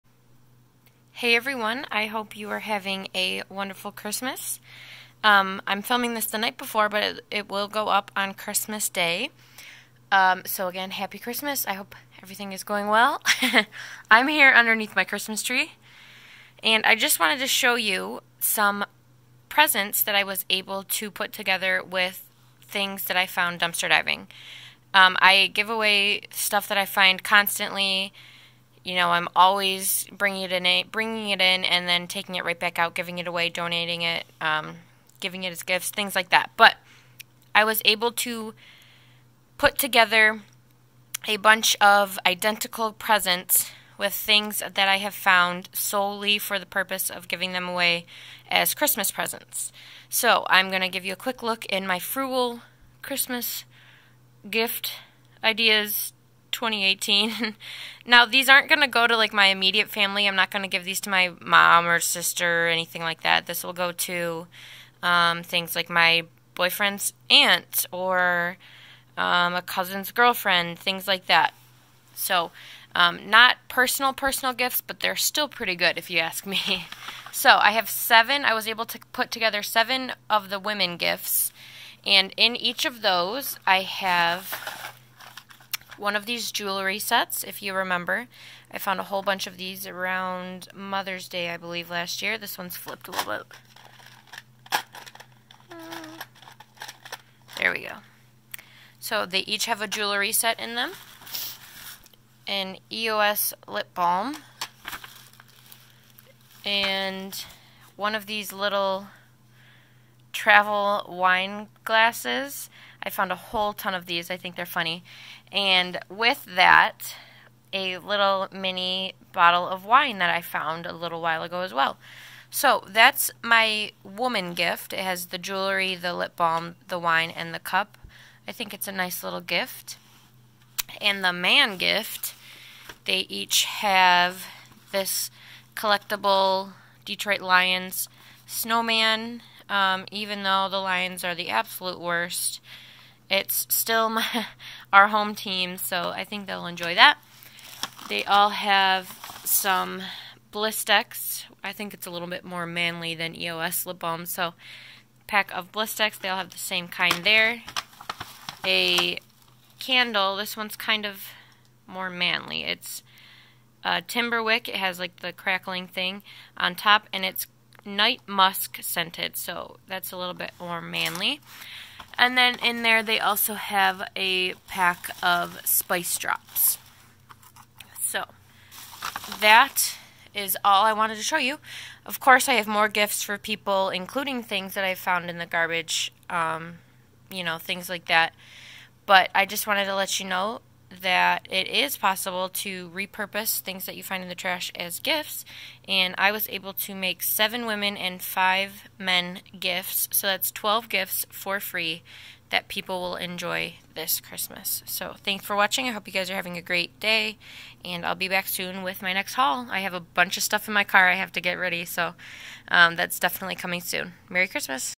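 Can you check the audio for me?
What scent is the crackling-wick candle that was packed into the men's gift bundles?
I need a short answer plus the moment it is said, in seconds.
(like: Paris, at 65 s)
Night musk, at 167 s.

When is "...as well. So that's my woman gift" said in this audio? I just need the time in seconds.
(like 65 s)
121 s.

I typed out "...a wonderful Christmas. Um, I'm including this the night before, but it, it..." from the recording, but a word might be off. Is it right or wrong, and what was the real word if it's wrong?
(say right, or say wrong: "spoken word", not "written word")
wrong: "filming", not "including".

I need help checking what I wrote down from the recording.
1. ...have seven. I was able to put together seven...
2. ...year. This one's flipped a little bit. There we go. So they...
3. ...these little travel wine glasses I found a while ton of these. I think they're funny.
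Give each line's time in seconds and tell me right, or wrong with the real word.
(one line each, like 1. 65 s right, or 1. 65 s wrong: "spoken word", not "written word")
1. 77 s right
2. 92 s right
3. 108 s wrong: "whole", not "while".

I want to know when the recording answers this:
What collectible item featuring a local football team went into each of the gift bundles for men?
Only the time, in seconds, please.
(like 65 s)
137 s.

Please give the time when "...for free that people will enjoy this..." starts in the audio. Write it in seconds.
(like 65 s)
201 s.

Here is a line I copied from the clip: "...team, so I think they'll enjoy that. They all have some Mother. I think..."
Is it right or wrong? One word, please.
wrong.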